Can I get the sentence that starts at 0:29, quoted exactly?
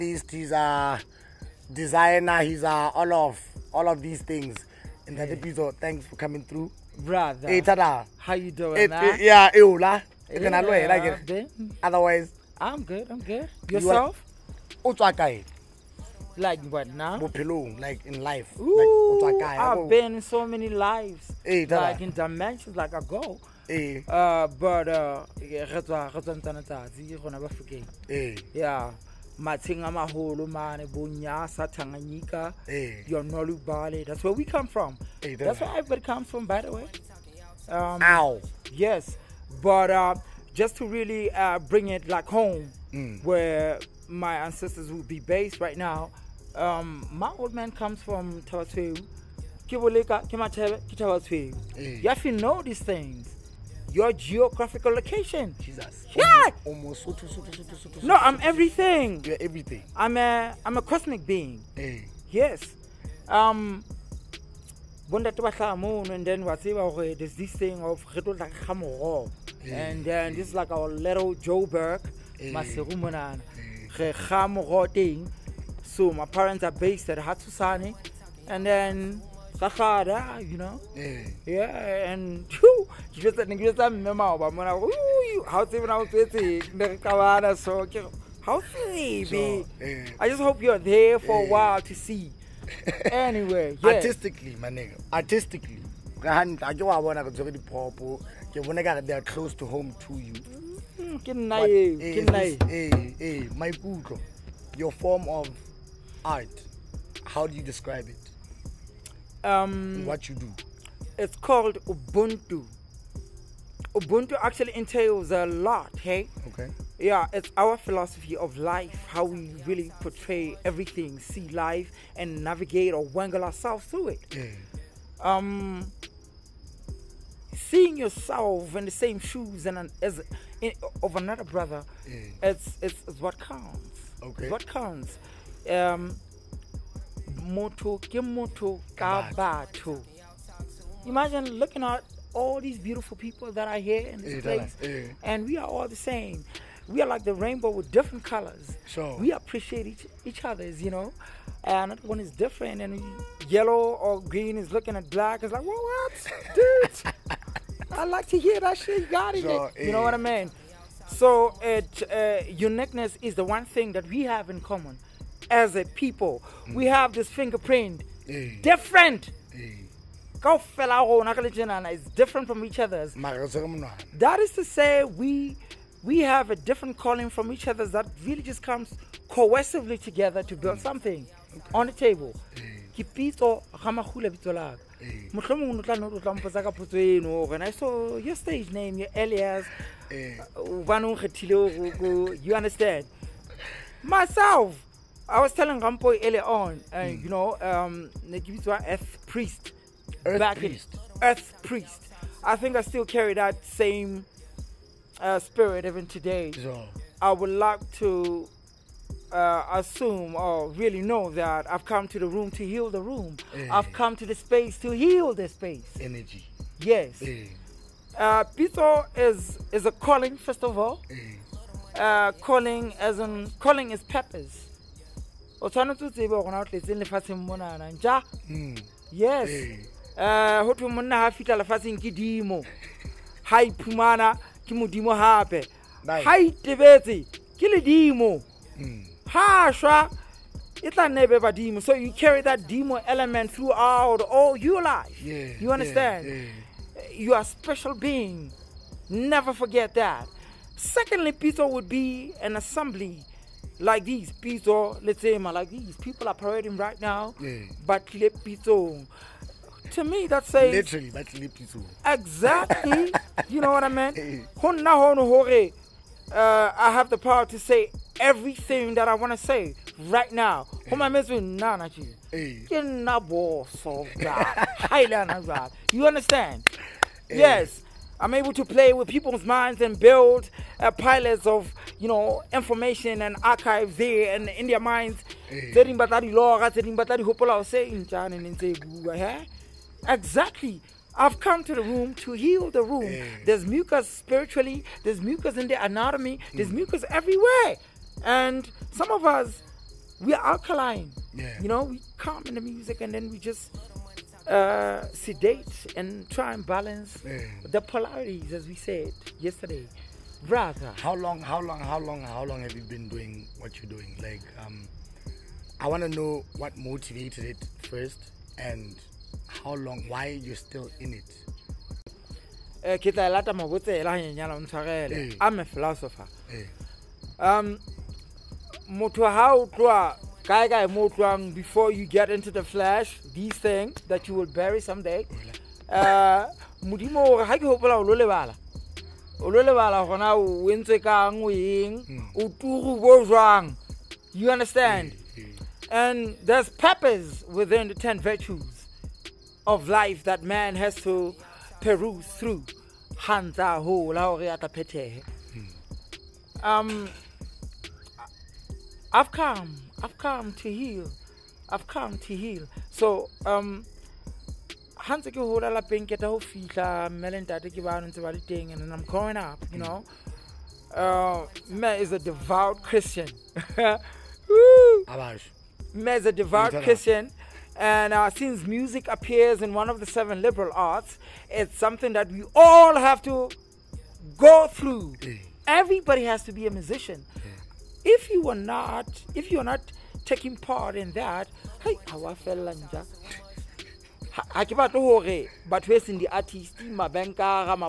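Matinga maholo mane bonyasa tanganyika hey.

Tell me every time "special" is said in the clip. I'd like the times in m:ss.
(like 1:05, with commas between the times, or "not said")
4:07.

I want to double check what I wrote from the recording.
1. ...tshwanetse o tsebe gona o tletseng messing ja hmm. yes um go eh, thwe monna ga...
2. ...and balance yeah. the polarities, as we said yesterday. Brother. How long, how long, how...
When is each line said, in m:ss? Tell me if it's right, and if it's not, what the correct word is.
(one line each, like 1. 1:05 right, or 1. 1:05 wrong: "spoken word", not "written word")
1. 3:45 wrong: "lefatsheng", not "messing"
2. 5:06 right.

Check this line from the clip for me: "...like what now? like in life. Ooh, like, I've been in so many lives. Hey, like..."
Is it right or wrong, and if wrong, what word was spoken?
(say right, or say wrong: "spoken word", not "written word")
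right.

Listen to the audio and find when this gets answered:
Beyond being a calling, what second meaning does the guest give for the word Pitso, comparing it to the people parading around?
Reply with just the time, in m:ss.
4:12.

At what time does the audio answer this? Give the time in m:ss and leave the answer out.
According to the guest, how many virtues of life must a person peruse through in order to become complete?
5:47.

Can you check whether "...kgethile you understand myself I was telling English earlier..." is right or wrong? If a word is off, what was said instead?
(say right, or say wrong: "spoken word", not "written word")
wrong: "Rampo", not "English".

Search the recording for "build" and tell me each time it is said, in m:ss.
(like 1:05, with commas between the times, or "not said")
3:00, 4:39.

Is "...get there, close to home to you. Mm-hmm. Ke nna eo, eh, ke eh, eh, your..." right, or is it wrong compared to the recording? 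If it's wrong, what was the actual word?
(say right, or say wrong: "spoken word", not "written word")
right.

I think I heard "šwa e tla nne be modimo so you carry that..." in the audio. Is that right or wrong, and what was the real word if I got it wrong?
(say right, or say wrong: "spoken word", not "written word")
wrong: "badimo", not "modimo".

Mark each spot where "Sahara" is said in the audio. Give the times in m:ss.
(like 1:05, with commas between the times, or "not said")
1:19.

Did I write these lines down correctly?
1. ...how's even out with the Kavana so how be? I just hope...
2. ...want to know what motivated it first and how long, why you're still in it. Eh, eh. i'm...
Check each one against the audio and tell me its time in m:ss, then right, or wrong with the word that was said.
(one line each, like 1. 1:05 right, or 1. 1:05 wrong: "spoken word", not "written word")
1. 1:25 right
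2. 5:15 right.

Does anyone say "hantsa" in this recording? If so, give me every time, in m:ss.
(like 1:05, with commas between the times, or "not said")
5:53.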